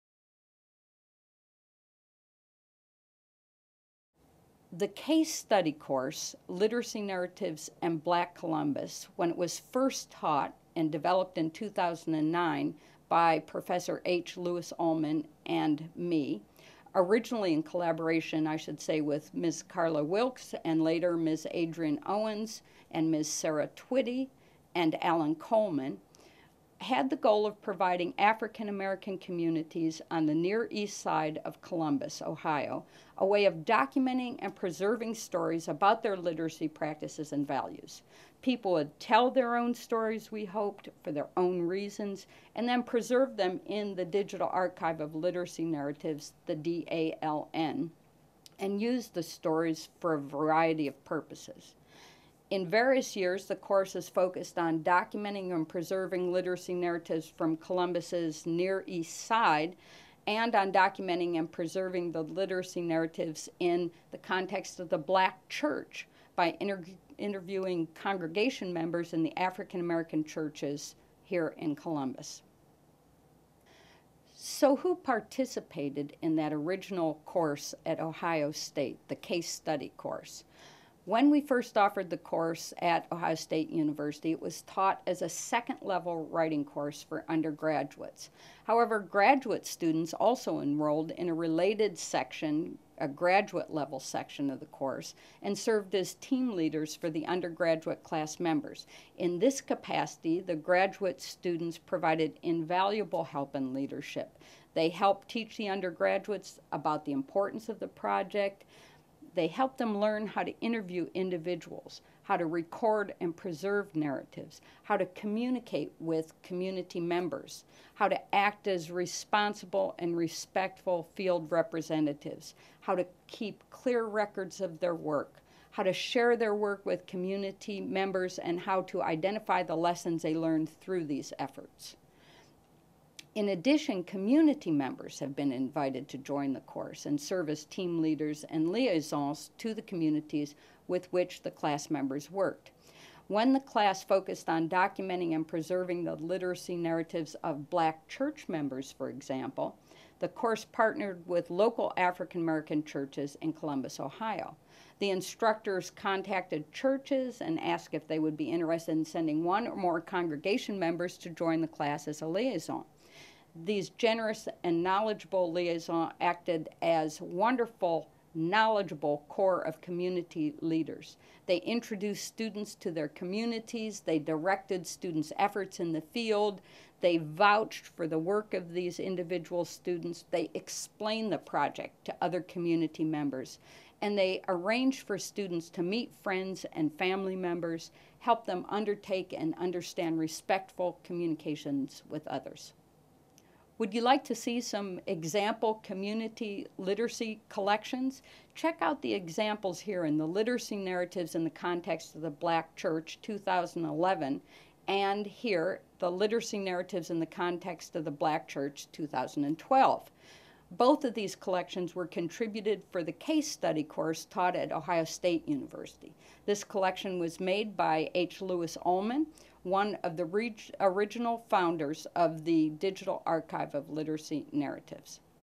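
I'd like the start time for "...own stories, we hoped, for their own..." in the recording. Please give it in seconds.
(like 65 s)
39 s.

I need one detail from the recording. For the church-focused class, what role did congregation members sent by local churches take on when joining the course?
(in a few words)
liaison.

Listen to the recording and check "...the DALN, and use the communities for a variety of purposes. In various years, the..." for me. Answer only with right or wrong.
wrong.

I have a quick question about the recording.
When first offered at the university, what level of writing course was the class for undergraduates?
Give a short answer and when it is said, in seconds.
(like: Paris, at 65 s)
second level, at 85 s.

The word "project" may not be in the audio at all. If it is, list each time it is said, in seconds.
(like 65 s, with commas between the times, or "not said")
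107 s, 181 s.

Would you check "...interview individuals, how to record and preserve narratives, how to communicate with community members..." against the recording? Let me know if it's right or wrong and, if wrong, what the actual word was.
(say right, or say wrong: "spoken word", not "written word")
right.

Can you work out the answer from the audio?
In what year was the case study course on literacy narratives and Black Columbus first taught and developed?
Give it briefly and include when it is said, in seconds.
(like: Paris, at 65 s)
2009, at 11 s.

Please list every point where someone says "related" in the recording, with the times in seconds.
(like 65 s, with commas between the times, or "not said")
91 s.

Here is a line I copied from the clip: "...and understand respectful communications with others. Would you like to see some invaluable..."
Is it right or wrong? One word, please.
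wrong.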